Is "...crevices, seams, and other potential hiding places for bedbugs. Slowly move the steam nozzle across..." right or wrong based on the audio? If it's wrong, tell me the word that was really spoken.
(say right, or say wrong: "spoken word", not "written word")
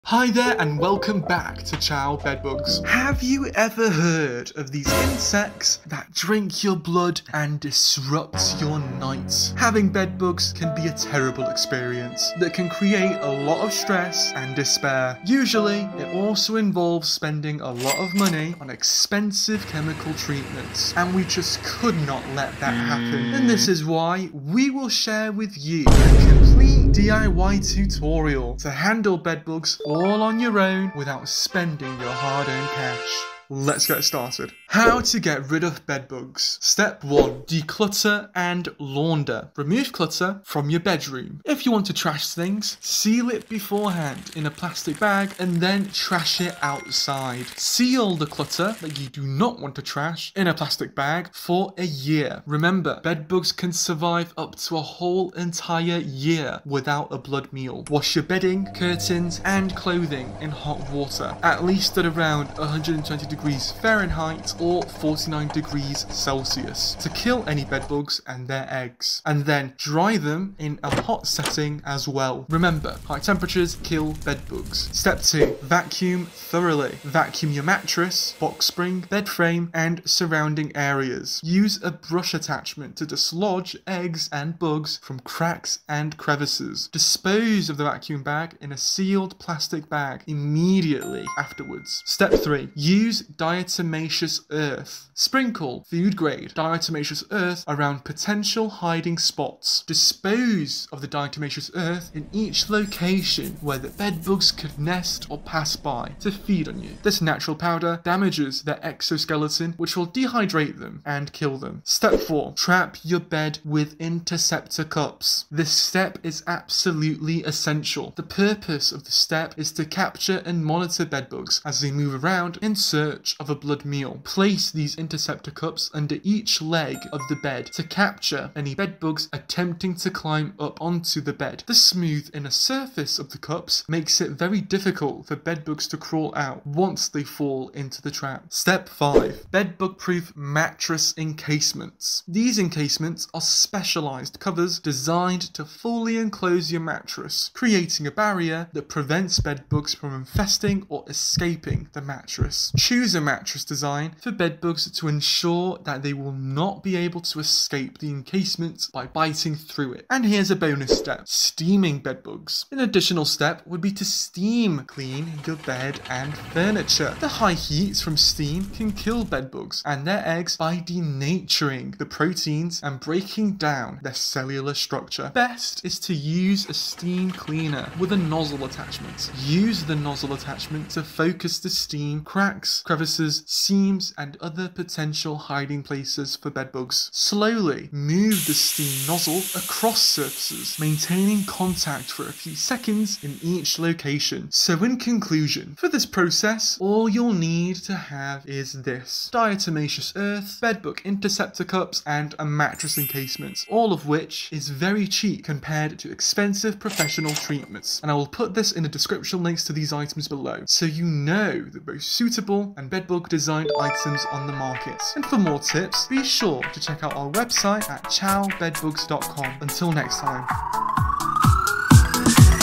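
right.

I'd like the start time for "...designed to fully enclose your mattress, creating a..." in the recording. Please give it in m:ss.
2:24.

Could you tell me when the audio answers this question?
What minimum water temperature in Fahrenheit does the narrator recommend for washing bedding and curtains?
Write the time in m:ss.
1:02.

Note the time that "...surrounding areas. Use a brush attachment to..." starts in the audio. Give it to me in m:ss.
1:20.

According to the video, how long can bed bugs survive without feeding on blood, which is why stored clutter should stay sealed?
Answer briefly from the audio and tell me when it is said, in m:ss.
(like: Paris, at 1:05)
a whole entire year, at 0:54.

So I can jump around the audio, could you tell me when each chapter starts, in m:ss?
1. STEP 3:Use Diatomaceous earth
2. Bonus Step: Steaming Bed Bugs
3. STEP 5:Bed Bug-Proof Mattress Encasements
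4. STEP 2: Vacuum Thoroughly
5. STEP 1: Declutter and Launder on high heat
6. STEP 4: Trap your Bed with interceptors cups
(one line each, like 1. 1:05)
1. 1:33
2. 2:41
3. 2:18
4. 1:16
5. 0:38
6. 1:52.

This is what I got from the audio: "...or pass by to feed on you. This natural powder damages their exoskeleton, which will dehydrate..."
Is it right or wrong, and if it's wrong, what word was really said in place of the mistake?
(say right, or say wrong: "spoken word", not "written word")
right.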